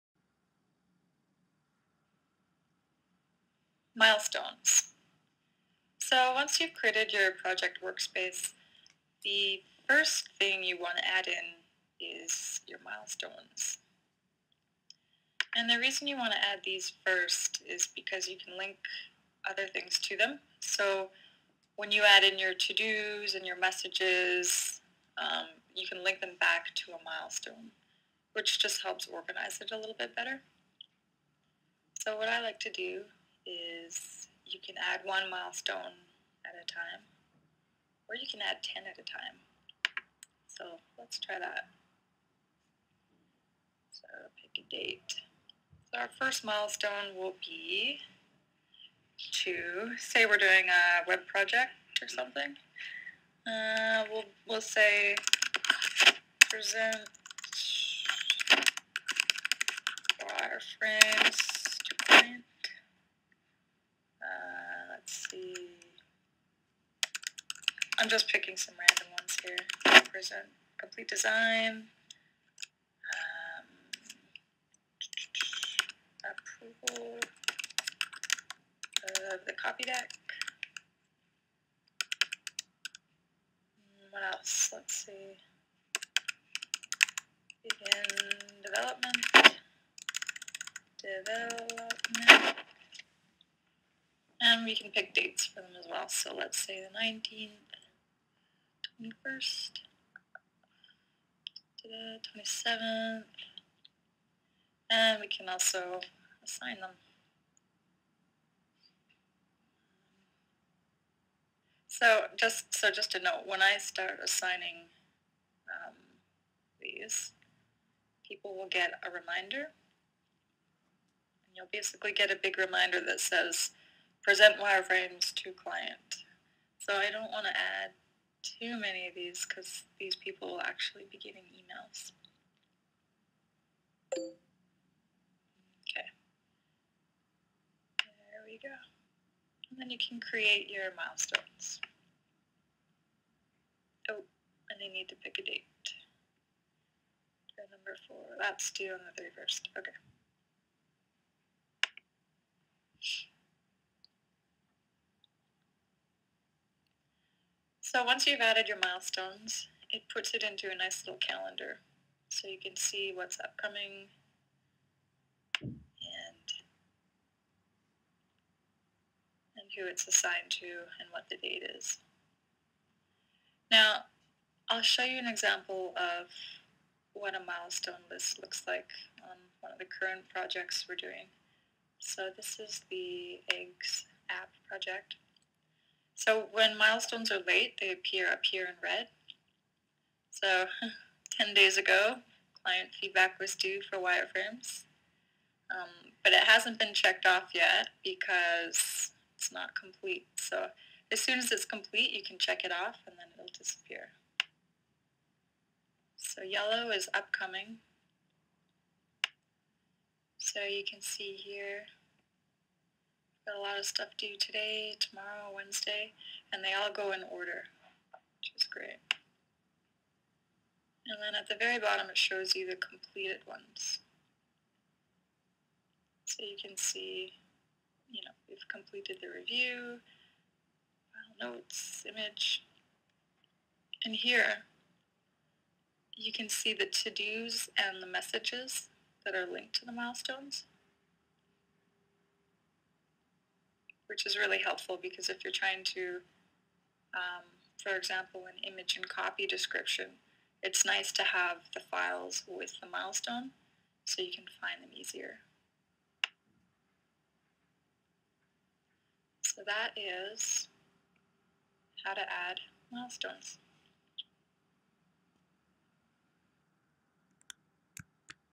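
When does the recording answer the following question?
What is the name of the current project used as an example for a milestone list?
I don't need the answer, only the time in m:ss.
3:03.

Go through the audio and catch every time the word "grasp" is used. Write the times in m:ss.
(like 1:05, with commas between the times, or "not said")
not said.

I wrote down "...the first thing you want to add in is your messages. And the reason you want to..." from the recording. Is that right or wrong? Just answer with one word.
wrong.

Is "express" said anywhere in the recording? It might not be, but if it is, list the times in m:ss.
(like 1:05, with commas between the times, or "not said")
not said.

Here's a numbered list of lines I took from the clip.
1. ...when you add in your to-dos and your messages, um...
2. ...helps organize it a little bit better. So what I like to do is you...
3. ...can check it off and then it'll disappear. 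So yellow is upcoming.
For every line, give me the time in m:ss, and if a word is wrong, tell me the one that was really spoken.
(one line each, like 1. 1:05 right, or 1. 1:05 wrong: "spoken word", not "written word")
1. 0:21 right
2. 0:28 right
3. 3:22 right.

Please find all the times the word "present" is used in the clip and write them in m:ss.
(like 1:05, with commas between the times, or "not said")
0:56, 1:10, 2:04.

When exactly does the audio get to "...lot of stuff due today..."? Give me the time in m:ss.
3:33.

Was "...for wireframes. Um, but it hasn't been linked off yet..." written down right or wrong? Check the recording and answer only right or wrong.
wrong.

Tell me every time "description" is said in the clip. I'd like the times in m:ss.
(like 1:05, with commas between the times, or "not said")
4:09.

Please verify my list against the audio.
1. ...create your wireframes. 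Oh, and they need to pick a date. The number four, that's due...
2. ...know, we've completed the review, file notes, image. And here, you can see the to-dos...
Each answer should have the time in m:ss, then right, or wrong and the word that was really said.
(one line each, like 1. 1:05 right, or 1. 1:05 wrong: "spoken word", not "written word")
1. 2:20 wrong: "milestones", not "wireframes"
2. 3:48 right.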